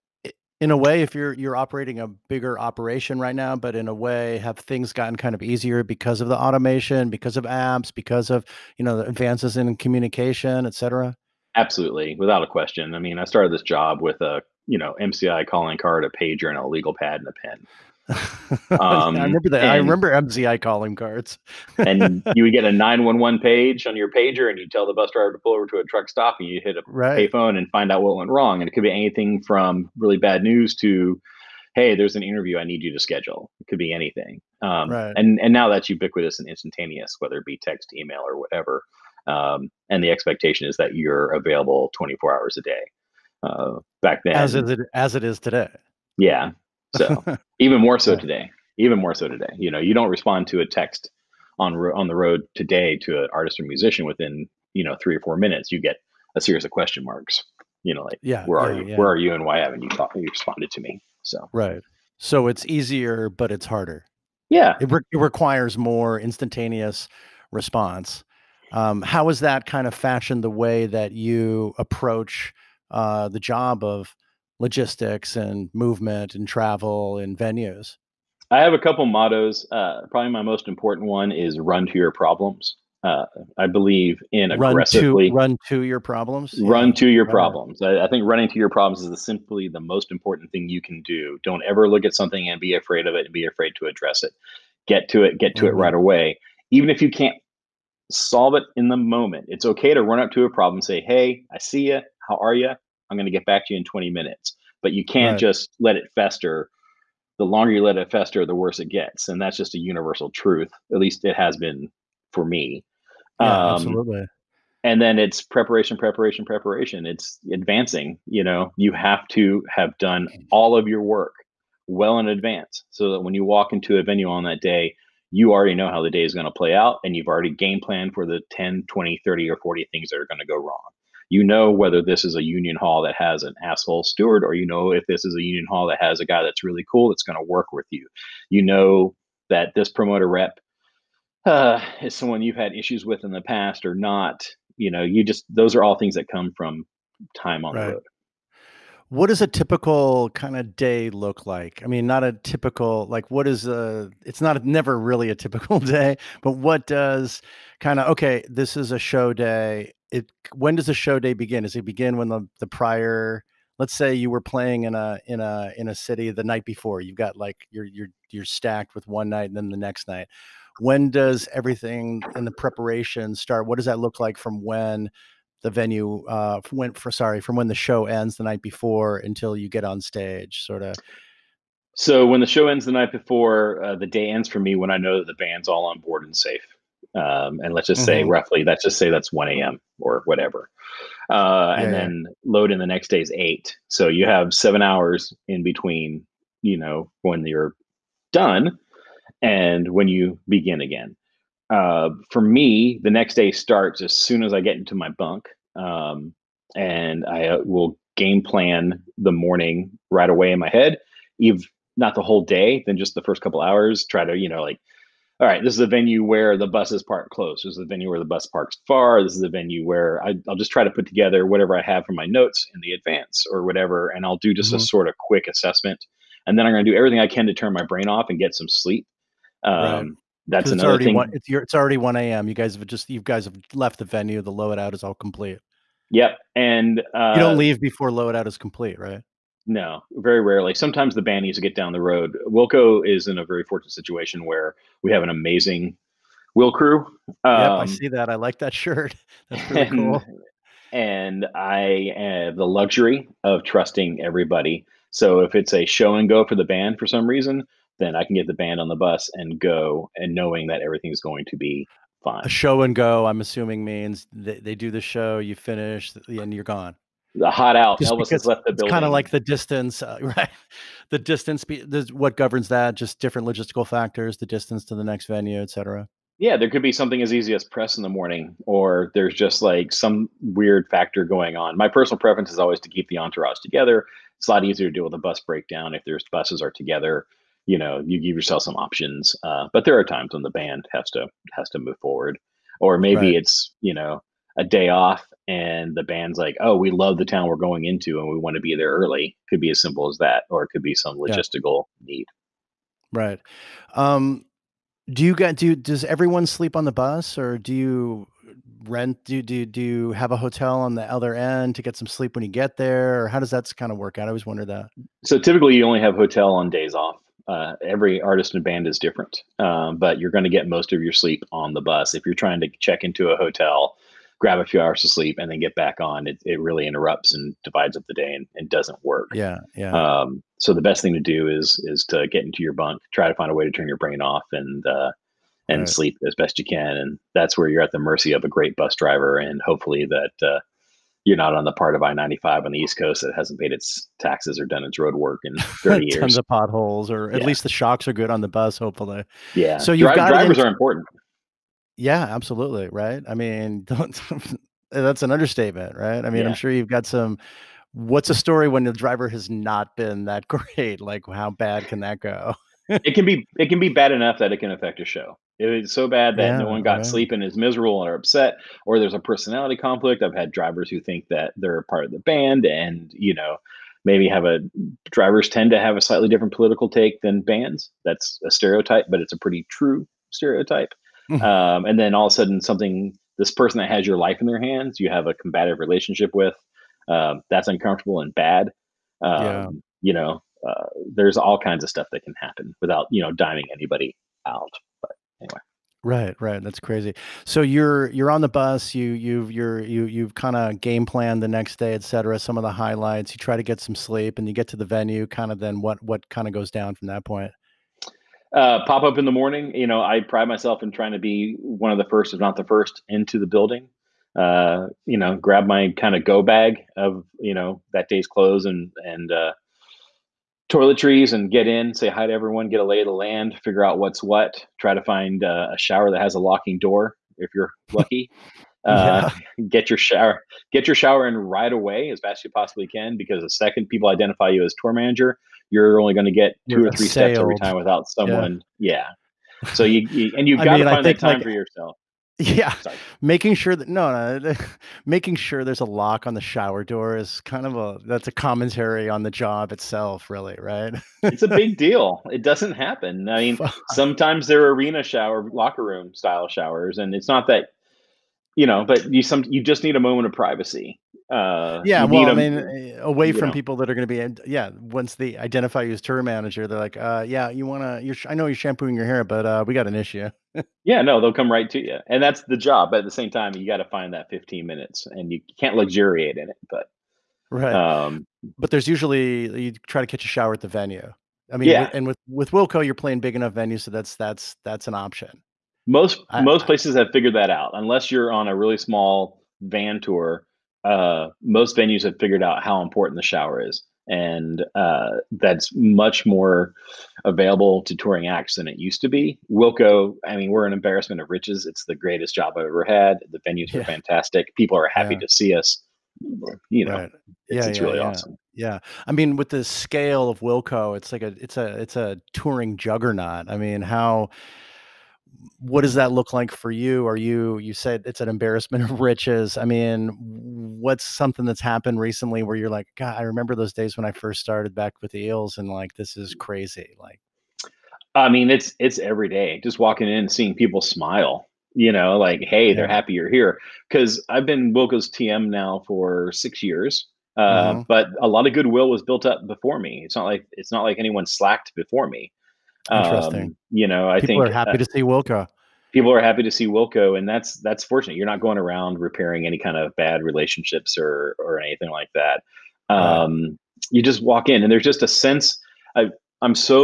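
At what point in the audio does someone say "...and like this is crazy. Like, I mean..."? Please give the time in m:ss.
8:45.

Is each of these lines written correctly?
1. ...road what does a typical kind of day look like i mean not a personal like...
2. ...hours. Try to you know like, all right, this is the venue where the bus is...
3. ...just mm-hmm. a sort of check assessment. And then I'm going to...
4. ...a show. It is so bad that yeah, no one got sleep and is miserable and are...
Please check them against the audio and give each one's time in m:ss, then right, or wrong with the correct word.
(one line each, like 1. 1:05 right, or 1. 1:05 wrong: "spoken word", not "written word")
1. 2:27 wrong: "typical", not "personal"
2. 3:33 right
3. 3:44 wrong: "quick", not "check"
4. 6:05 right.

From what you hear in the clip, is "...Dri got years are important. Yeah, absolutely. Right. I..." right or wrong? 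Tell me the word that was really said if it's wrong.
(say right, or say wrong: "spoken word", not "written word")
wrong: "drivers", not "years".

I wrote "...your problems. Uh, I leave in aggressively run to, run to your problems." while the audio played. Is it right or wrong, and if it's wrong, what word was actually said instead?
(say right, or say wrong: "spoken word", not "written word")
wrong: "believe", not "leave".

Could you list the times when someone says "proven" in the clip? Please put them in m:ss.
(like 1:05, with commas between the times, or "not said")
not said.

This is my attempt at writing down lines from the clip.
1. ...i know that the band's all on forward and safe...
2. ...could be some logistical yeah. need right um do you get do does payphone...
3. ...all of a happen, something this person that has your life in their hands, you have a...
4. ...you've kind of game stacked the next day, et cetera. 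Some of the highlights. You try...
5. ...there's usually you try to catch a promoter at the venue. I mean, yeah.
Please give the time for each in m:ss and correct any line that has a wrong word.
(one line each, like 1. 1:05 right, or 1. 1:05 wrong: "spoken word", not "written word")
1. 3:04 wrong: "board", not "forward"
2. 5:00 wrong: "everyone", not "payphone"
3. 6:22 wrong: "sudden", not "happen"
4. 6:40 wrong: "planned", not "stacked"
5. 7:58 wrong: "shower", not "promoter".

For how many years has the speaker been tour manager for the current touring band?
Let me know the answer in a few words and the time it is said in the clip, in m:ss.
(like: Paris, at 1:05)
6, at 8:56.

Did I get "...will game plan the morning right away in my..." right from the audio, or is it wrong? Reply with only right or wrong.
right.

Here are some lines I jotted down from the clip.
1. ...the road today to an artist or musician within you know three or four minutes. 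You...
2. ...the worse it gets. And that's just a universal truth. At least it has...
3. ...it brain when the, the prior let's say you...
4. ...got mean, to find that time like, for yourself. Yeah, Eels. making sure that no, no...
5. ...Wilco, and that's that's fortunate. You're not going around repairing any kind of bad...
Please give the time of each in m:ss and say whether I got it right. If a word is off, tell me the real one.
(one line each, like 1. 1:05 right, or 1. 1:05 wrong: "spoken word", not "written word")
1. 0:52 right
2. 1:48 right
3. 2:41 wrong: "begin", not "brain"
4. 7:20 wrong: "Sorry", not "Eels"
5. 9:06 right.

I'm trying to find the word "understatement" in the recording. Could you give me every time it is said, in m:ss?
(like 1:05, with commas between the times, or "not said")
5:55.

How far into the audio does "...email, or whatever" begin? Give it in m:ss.
0:37.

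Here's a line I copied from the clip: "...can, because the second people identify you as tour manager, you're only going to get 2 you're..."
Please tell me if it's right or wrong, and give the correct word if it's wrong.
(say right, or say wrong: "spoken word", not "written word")
right.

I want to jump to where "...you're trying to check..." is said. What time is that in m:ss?
5:22.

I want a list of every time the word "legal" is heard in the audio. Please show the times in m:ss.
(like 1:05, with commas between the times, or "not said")
0:16.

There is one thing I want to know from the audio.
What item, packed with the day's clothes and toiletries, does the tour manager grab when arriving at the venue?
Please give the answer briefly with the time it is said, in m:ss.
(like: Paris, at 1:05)
go bag, at 6:56.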